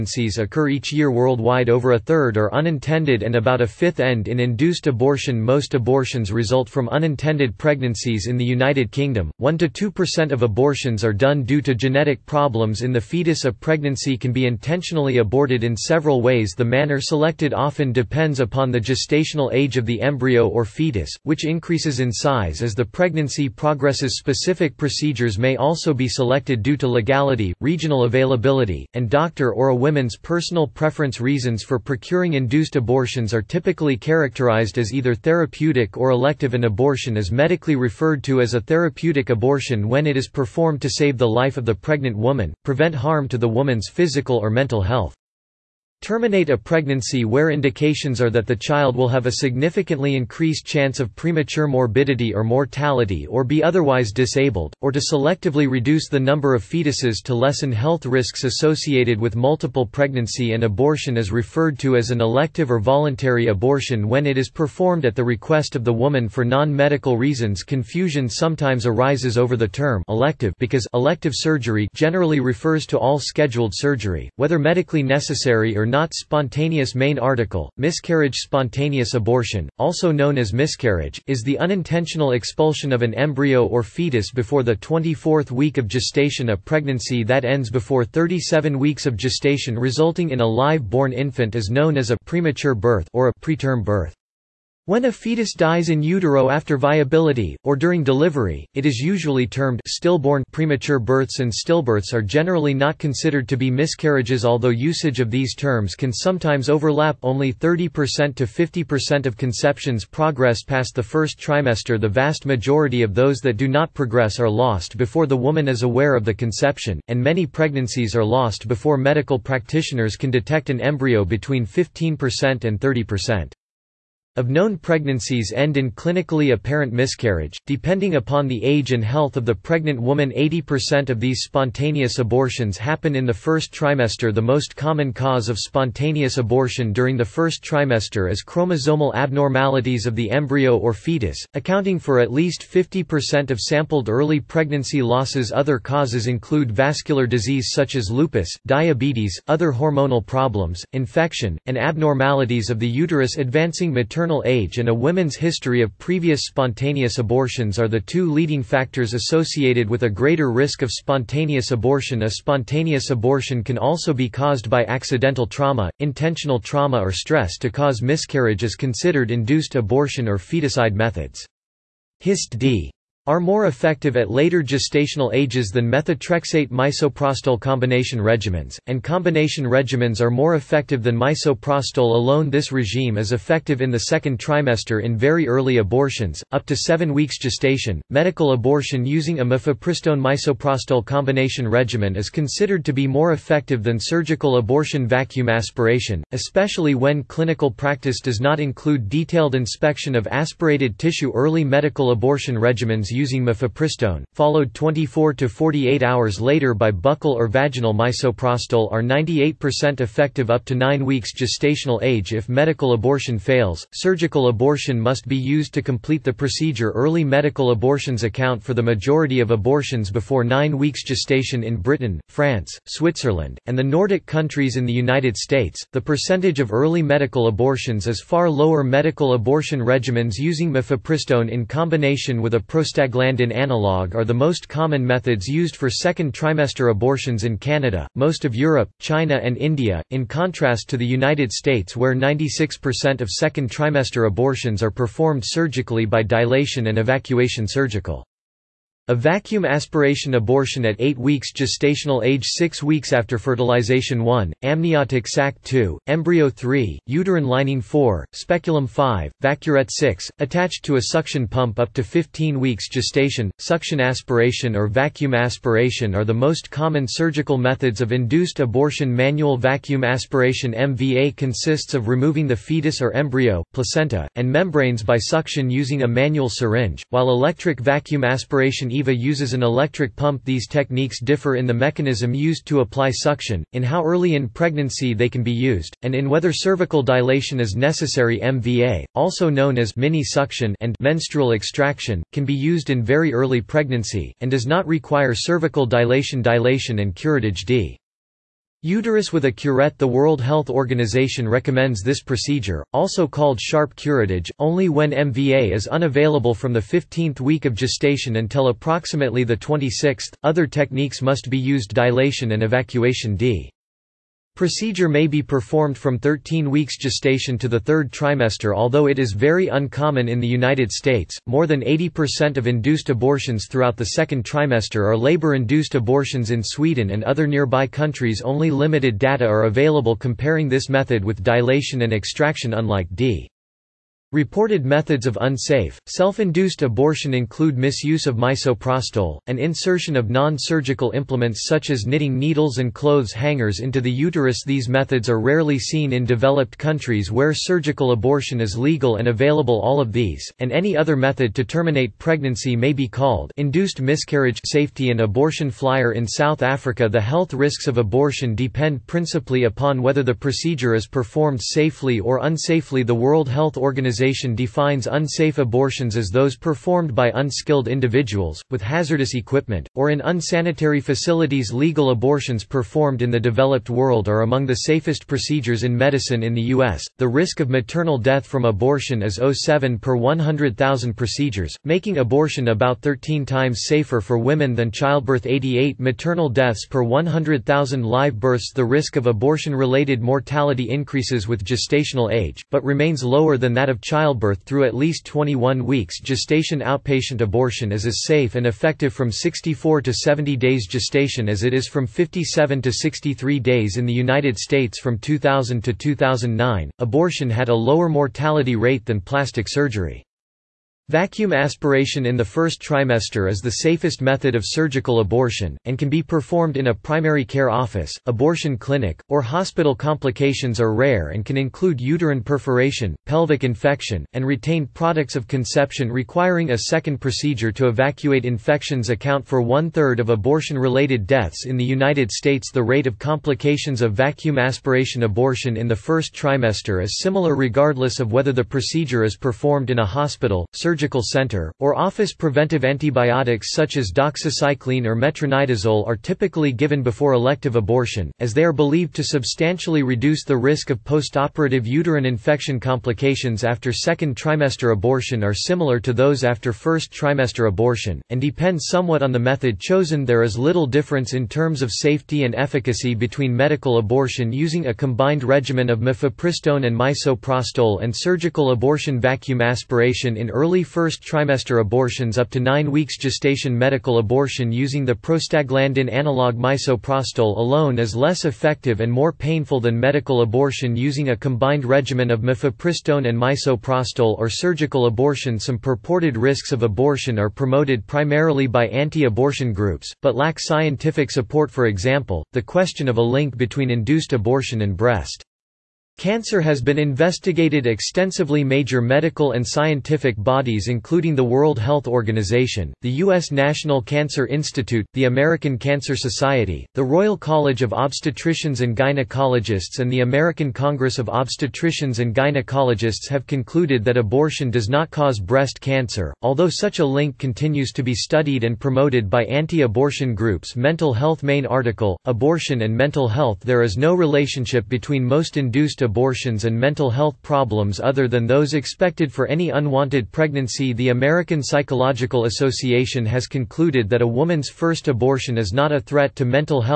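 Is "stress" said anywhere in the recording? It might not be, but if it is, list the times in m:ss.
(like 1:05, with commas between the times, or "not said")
2:47.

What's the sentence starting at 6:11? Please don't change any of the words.
Legal abortions performed in the developed world are among the safest procedures in medicine in the U.S.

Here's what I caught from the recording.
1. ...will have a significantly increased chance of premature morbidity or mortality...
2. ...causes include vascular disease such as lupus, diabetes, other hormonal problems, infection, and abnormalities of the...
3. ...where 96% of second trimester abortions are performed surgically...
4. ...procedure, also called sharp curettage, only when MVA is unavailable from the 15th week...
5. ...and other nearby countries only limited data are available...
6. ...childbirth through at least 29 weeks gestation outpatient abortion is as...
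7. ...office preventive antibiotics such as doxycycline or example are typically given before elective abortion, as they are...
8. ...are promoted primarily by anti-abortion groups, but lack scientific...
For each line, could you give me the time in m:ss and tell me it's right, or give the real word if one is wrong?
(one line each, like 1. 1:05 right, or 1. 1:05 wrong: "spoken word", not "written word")
1. 0:48 right
2. 2:25 right
3. 4:01 right
4. 5:02 right
5. 5:27 right
6. 6:34 wrong: "21", not "29"
7. 7:21 wrong: "metronidazole", not "example"
8. 8:07 right.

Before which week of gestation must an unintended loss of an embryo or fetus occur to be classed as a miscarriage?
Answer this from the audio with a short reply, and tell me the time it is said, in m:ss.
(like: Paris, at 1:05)
24th week, at 1:24.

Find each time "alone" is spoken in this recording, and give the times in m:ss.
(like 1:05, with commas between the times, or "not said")
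3:02, 7:57.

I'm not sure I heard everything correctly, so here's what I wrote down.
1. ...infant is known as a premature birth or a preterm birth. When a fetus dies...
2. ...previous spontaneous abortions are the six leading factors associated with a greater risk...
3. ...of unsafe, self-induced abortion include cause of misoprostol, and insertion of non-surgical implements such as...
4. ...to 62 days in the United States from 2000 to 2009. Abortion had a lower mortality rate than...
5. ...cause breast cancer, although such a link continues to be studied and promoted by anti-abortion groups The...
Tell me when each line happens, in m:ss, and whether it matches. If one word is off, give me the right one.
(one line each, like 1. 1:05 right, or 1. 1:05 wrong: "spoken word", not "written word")
1. 1:31 right
2. 2:35 wrong: "two", not "six"
3. 5:35 wrong: "misuse", not "cause"
4. 6:42 wrong: "63", not "62"
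5. 8:35 wrong: "Mental", not "The".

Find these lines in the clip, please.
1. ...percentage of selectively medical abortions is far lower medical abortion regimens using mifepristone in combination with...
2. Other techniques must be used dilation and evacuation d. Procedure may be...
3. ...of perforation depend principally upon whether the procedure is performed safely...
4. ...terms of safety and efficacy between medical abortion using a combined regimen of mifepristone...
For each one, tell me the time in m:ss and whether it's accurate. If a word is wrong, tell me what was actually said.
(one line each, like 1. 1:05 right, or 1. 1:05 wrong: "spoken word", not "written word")
1. 3:46 wrong: "early", not "selectively"
2. 5:10 right
3. 5:57 wrong: "abortion", not "perforation"
4. 7:41 right.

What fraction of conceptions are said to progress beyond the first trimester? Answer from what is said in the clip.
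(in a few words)
30% to 50%.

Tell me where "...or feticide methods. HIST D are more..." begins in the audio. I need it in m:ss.
2:50.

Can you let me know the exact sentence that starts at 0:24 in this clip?
Specific procedures may also be selected due to legality, regional availability, and doctor or a woman's personal preference.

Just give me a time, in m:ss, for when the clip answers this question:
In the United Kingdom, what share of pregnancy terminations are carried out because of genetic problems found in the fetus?
0:09.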